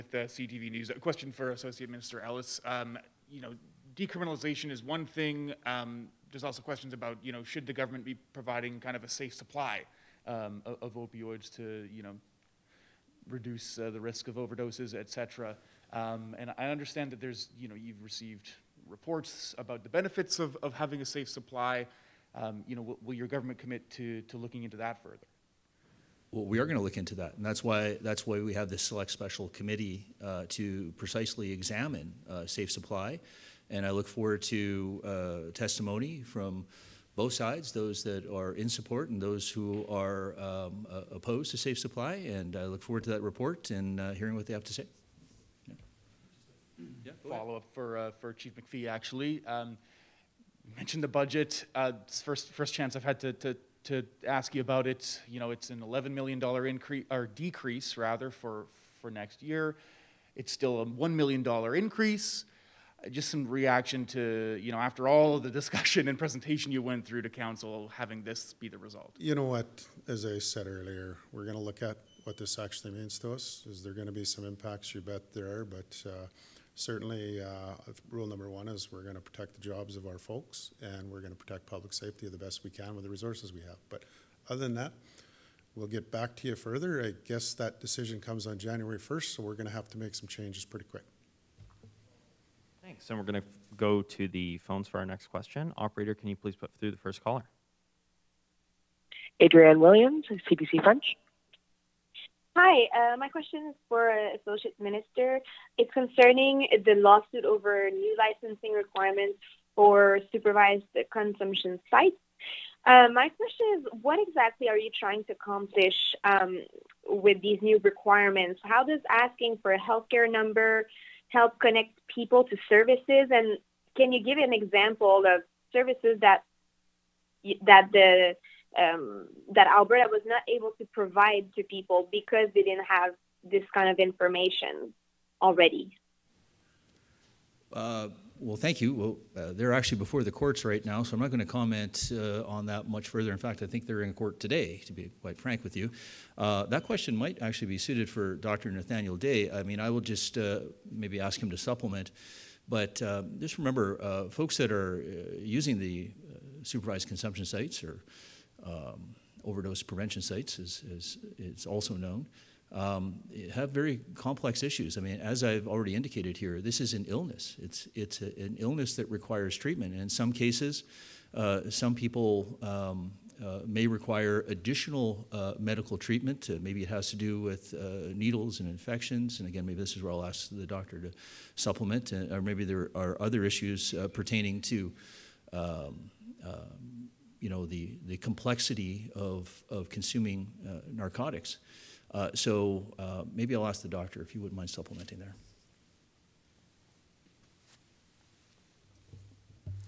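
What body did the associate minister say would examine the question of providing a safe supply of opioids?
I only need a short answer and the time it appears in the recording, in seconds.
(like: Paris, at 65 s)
select special committee, at 28 s.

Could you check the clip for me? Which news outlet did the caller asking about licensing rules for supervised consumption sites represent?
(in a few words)
CBC French.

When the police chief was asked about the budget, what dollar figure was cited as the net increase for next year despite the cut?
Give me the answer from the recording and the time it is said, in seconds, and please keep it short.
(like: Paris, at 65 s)
$1 million, at 60 s.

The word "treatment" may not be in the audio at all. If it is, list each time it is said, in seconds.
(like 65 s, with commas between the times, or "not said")
169 s, 175 s.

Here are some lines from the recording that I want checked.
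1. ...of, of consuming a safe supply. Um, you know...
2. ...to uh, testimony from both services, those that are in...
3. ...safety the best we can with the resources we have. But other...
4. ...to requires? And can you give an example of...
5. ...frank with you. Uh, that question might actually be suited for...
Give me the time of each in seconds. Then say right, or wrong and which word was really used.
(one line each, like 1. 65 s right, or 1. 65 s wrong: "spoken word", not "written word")
1. 20 s wrong: "having", not "consuming"
2. 34 s wrong: "sides", not "services"
3. 81 s right
4. 122 s wrong: "services", not "requires"
5. 145 s right.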